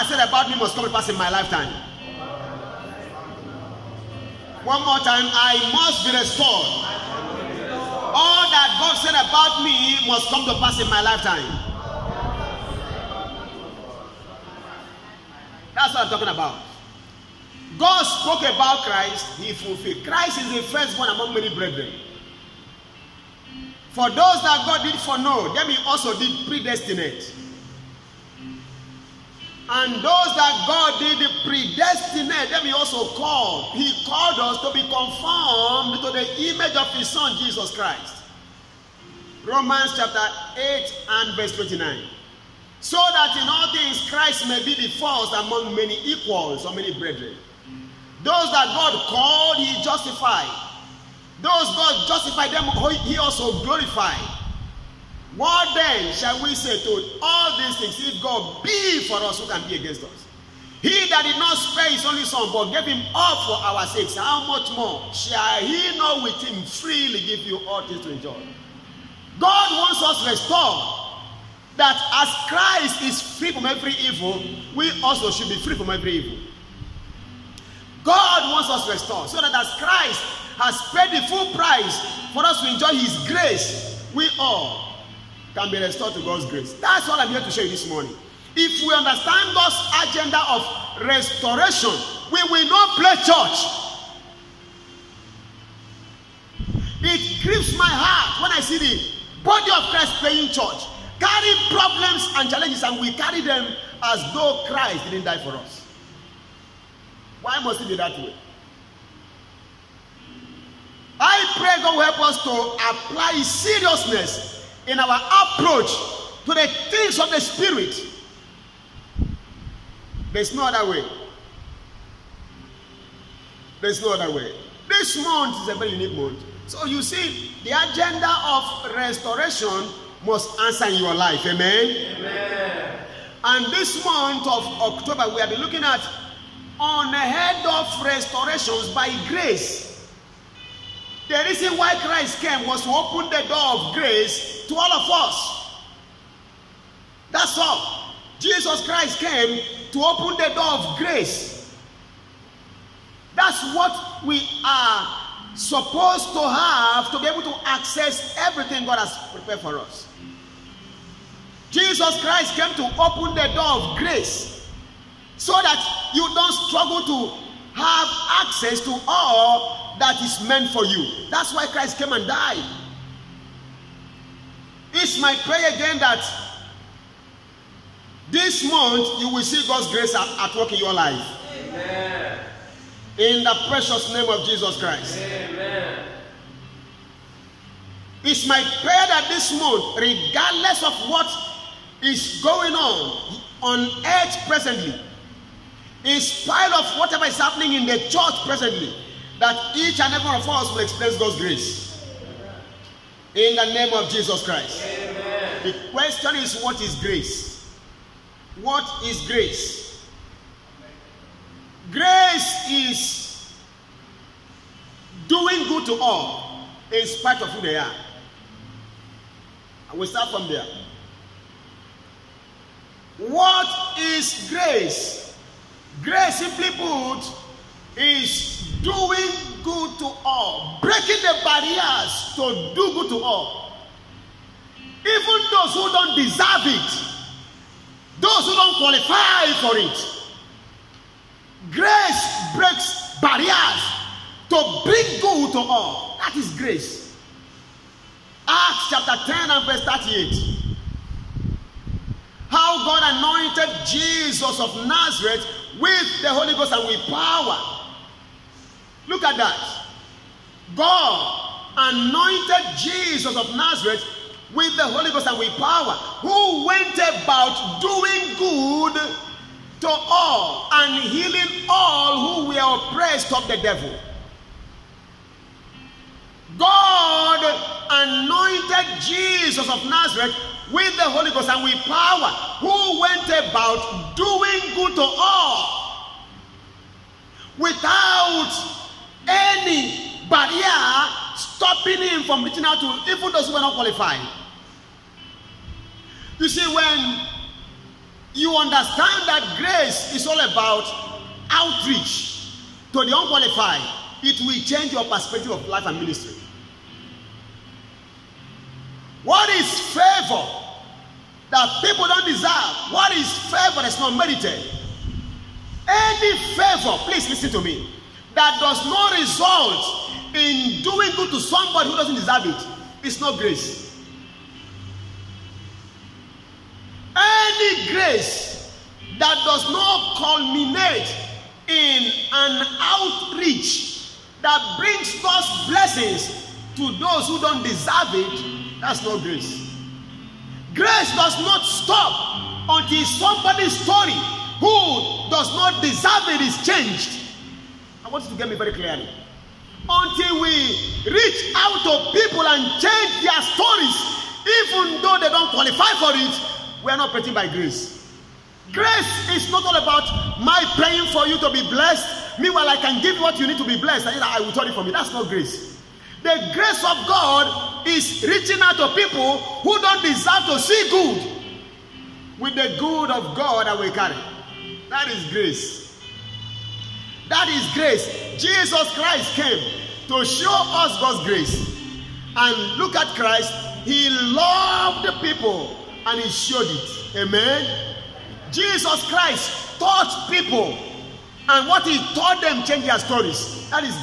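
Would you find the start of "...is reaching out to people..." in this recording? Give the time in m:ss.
6:07.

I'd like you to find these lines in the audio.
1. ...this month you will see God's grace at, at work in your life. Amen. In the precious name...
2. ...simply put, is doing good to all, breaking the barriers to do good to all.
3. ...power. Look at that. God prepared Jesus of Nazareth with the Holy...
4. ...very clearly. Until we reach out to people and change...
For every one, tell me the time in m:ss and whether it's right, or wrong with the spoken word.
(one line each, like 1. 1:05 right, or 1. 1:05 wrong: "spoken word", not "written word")
1. 2:58 right
2. 3:46 right
3. 4:17 wrong: "anointed", not "prepared"
4. 5:48 right.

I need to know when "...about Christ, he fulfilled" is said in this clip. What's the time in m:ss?
0:18.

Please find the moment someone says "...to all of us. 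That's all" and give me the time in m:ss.
2:24.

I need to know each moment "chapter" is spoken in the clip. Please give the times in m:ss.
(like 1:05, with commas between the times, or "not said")
0:39, 4:08.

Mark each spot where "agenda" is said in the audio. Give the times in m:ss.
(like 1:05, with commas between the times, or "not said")
1:30, 2:07.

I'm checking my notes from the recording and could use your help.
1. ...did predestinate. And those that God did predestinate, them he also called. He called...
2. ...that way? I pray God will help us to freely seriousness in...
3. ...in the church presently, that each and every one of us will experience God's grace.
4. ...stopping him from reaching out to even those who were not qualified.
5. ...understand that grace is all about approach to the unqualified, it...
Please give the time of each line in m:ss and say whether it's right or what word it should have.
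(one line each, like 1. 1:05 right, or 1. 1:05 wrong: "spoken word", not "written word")
1. 0:26 right
2. 1:47 wrong: "apply", not "freely"
3. 3:17 right
4. 4:51 right
5. 4:58 wrong: "outreach", not "approach".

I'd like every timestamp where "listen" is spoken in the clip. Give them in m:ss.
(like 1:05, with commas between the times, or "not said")
5:17.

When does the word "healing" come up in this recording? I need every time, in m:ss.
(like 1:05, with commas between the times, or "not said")
4:31.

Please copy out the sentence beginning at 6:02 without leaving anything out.
Meanwhile, I can give what you need to be blessed.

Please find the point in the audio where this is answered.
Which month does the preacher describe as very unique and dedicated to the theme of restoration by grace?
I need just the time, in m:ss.
2:14.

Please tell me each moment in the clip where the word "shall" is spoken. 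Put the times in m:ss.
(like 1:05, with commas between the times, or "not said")
0:56, 1:05.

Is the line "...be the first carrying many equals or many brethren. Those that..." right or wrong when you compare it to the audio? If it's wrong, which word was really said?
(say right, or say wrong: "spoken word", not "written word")
wrong: "among", not "carrying".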